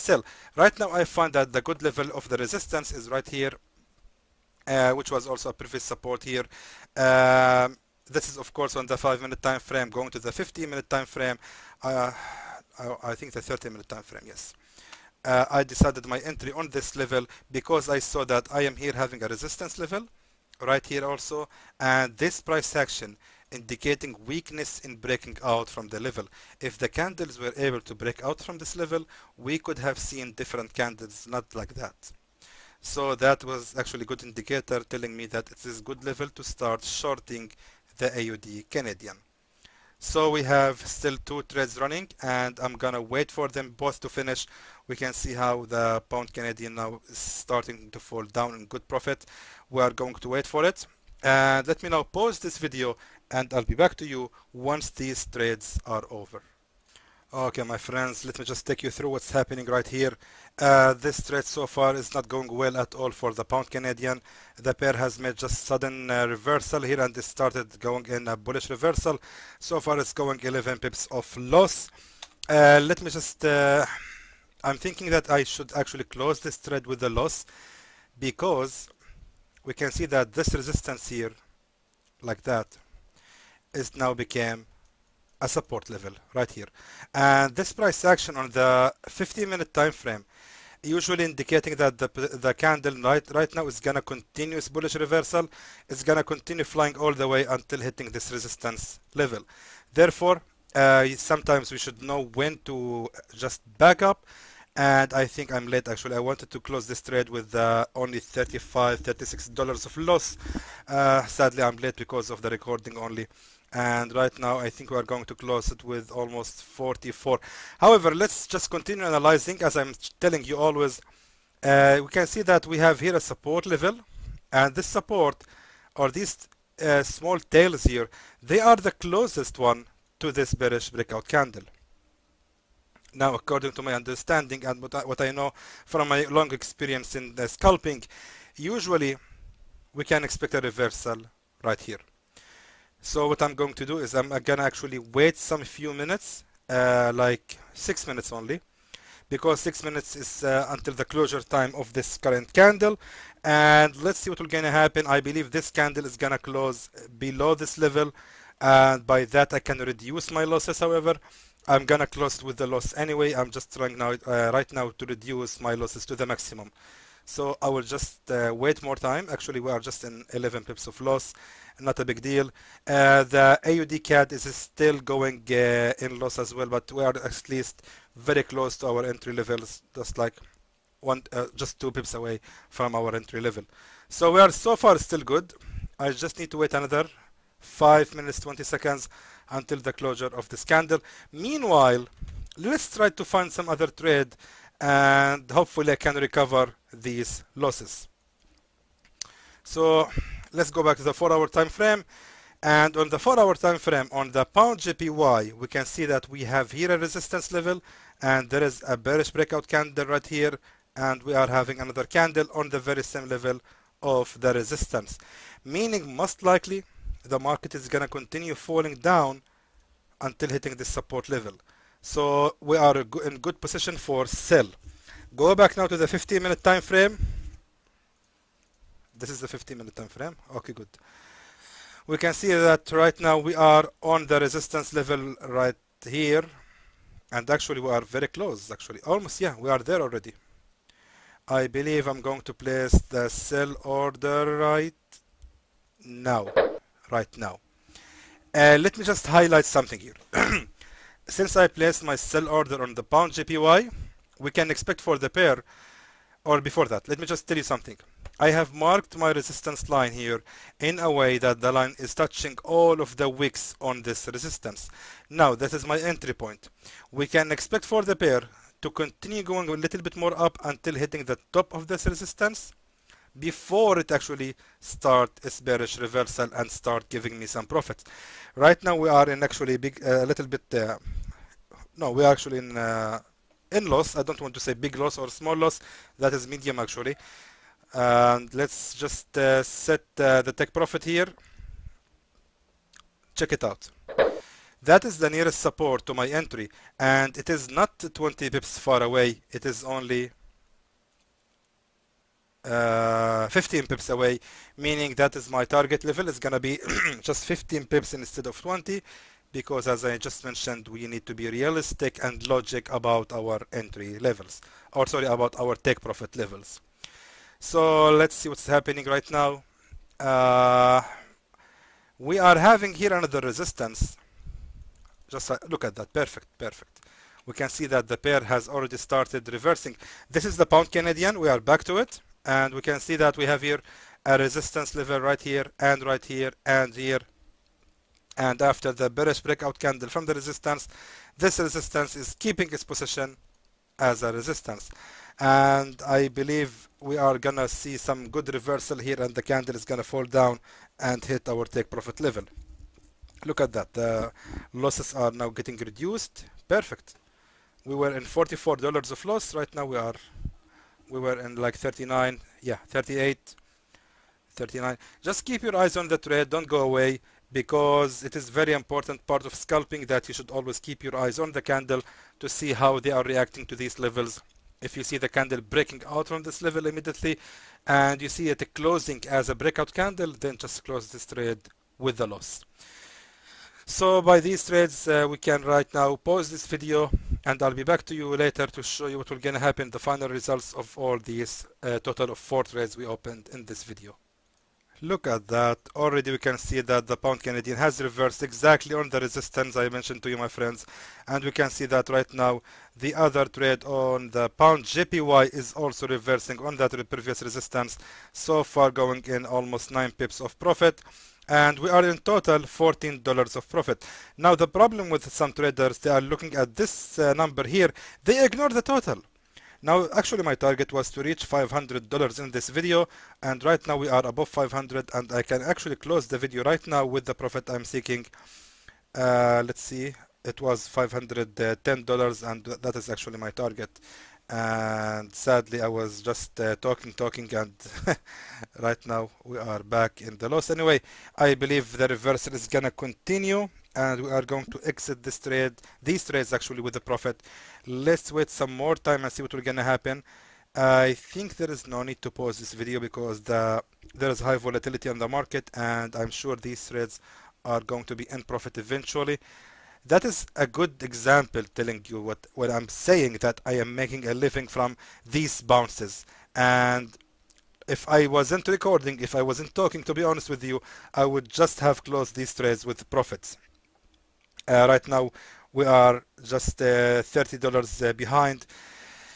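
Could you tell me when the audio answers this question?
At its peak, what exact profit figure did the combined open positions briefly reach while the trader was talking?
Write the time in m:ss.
7:10.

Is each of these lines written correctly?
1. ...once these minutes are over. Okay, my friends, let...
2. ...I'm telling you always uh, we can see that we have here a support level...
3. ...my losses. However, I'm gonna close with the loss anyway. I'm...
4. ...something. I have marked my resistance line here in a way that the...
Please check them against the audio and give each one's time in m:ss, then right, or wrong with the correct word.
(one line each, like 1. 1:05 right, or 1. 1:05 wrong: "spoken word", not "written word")
1. 0:54 wrong: "trades", not "minutes"
2. 1:59 right
3. 2:40 right
4. 4:17 right.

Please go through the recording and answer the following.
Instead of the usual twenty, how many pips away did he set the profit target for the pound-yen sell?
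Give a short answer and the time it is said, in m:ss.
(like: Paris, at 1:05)
15 pips, at 5:03.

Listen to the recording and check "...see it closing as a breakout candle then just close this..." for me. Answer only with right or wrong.
right.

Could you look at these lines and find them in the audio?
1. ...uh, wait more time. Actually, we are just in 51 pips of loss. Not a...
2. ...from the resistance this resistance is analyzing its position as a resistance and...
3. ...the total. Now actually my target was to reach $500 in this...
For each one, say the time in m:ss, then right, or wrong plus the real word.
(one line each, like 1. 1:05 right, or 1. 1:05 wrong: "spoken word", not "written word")
1. 2:48 wrong: "11", not "51"
2. 5:40 wrong: "keeping", not "analyzing"
3. 6:58 right.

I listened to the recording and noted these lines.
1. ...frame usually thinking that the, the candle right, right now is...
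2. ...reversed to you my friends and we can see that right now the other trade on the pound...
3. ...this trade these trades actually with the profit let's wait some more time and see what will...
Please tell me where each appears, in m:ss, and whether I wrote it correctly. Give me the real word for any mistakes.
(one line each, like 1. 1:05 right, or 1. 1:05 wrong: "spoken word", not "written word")
1. 1:29 wrong: "indicating", not "thinking"
2. 6:39 wrong: "mentioned", not "reversed"
3. 7:25 right.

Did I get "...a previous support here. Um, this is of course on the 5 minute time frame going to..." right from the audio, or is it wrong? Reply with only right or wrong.
right.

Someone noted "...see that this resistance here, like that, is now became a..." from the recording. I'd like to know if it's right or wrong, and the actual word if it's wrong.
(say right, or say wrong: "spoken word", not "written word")
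right.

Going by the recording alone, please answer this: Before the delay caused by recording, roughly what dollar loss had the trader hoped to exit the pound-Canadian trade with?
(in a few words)
35-36 dollars.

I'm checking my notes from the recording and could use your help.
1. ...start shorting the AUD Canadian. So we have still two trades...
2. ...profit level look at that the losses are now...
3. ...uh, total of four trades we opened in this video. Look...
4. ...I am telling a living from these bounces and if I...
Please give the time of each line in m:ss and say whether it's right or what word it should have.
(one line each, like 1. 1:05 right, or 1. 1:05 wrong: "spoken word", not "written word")
1. 0:36 right
2. 5:51 right
3. 6:31 right
4. 7:43 wrong: "making", not "telling".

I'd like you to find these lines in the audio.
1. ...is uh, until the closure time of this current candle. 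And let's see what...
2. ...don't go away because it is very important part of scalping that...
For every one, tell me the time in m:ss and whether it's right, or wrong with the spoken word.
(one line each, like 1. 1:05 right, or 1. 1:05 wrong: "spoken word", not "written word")
1. 2:30 right
2. 6:06 right.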